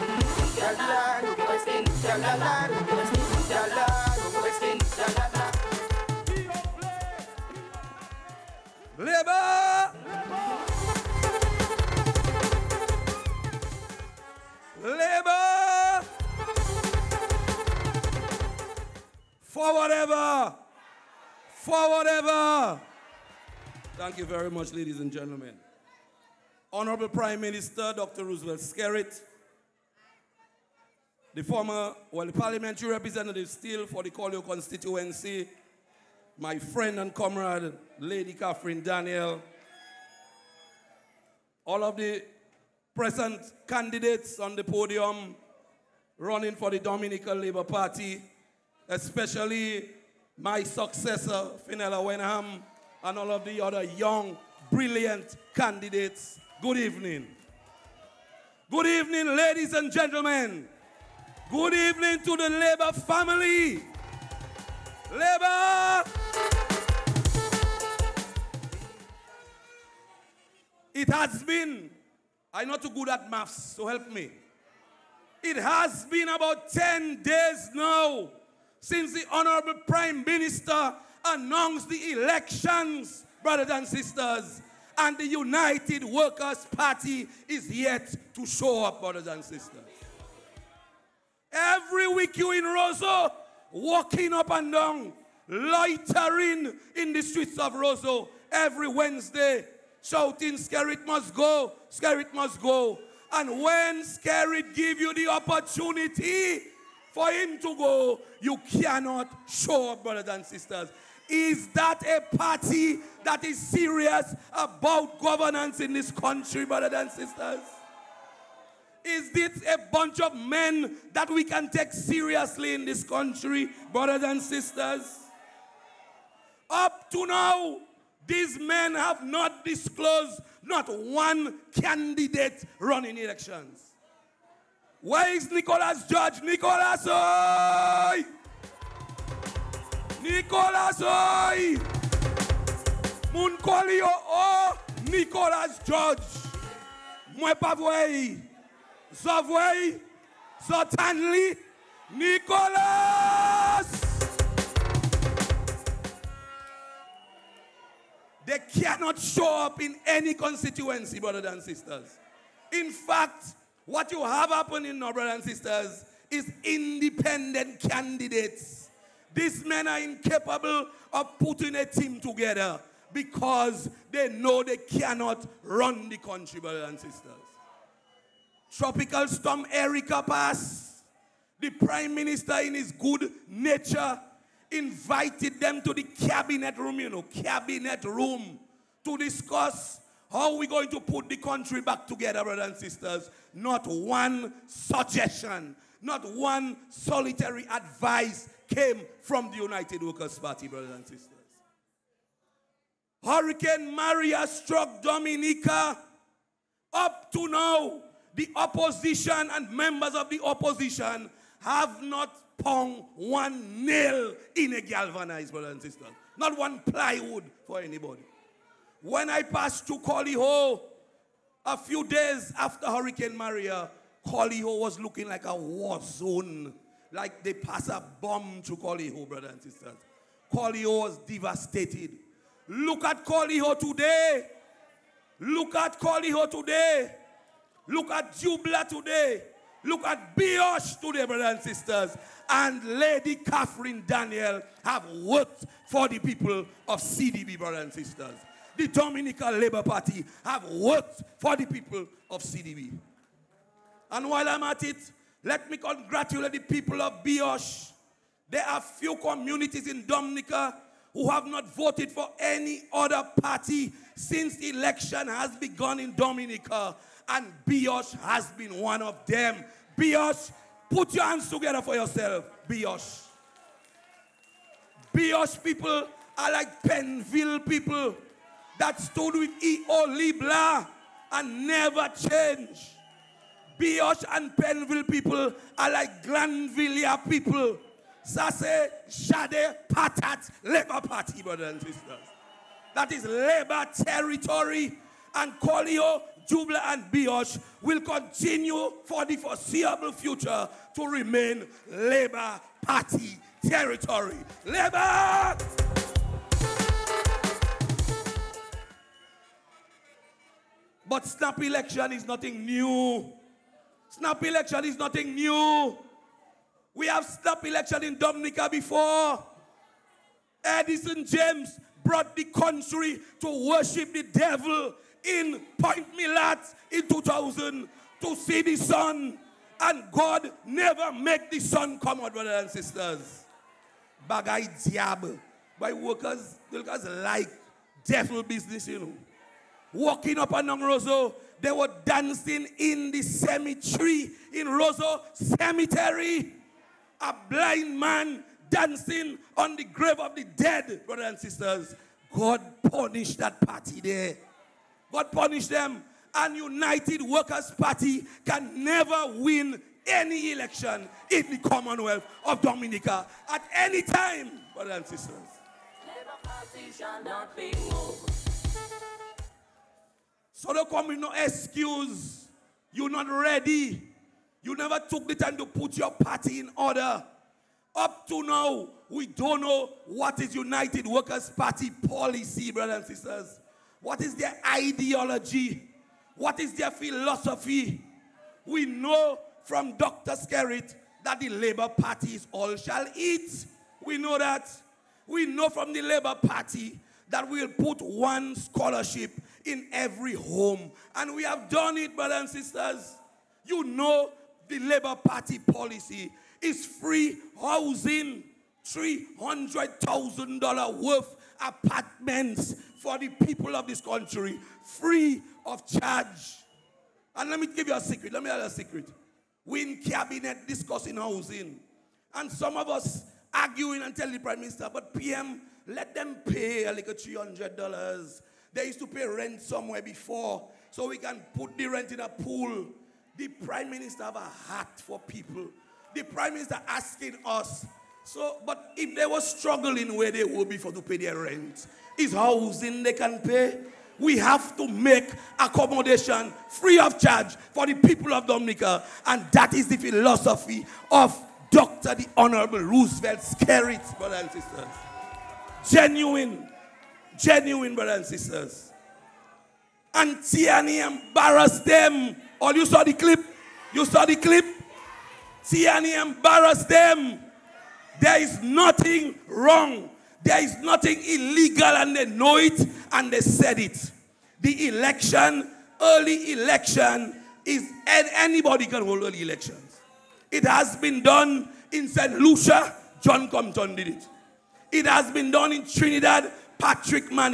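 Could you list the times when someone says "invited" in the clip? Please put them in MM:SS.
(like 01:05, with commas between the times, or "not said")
03:04.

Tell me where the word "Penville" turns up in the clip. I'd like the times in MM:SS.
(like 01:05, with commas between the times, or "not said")
04:36, 04:44.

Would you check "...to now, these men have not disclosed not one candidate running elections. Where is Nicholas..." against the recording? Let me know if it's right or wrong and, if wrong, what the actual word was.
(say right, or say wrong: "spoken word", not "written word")
right.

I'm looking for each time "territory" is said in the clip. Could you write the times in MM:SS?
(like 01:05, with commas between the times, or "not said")
04:53, 05:03.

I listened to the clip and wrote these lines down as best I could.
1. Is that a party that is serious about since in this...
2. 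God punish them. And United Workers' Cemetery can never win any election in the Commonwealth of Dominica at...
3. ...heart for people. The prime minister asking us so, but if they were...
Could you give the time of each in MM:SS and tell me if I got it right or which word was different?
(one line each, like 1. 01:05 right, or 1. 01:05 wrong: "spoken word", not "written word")
1. 01:51 wrong: "governance", not "since"
2. 05:55 wrong: "Party", not "Cemetery"
3. 07:14 right.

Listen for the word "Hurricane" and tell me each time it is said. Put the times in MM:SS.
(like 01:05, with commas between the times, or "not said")
03:23, 03:42.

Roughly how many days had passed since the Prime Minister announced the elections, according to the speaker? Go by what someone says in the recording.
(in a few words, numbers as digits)
10.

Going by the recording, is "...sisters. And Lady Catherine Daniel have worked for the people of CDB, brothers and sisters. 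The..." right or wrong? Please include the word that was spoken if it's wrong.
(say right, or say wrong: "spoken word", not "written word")
right.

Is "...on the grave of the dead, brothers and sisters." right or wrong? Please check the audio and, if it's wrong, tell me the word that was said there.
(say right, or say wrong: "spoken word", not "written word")
right.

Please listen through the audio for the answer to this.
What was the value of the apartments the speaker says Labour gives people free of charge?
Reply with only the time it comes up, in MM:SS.
06:48.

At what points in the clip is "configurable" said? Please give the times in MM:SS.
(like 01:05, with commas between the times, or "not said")
not said.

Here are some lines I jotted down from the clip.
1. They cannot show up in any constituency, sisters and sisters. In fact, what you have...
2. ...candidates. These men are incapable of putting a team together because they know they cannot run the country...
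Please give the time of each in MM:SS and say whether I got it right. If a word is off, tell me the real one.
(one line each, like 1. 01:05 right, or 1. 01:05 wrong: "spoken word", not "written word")
1. 02:38 wrong: "brothers", not "sisters"
2. 02:47 right.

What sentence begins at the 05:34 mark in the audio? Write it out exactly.
bagai diable, By workers, workers like devil business, you know.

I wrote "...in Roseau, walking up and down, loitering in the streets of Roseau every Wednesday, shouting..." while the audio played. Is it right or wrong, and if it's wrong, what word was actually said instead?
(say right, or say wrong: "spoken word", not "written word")
right.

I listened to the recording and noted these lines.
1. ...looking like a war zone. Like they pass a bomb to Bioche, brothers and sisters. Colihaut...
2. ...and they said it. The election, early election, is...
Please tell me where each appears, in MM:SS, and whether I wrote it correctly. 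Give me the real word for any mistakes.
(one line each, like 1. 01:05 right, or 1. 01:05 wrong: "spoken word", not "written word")
1. 03:44 wrong: "Colihaut", not "Bioche"
2. 07:53 right.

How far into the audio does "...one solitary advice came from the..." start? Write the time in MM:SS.
03:16.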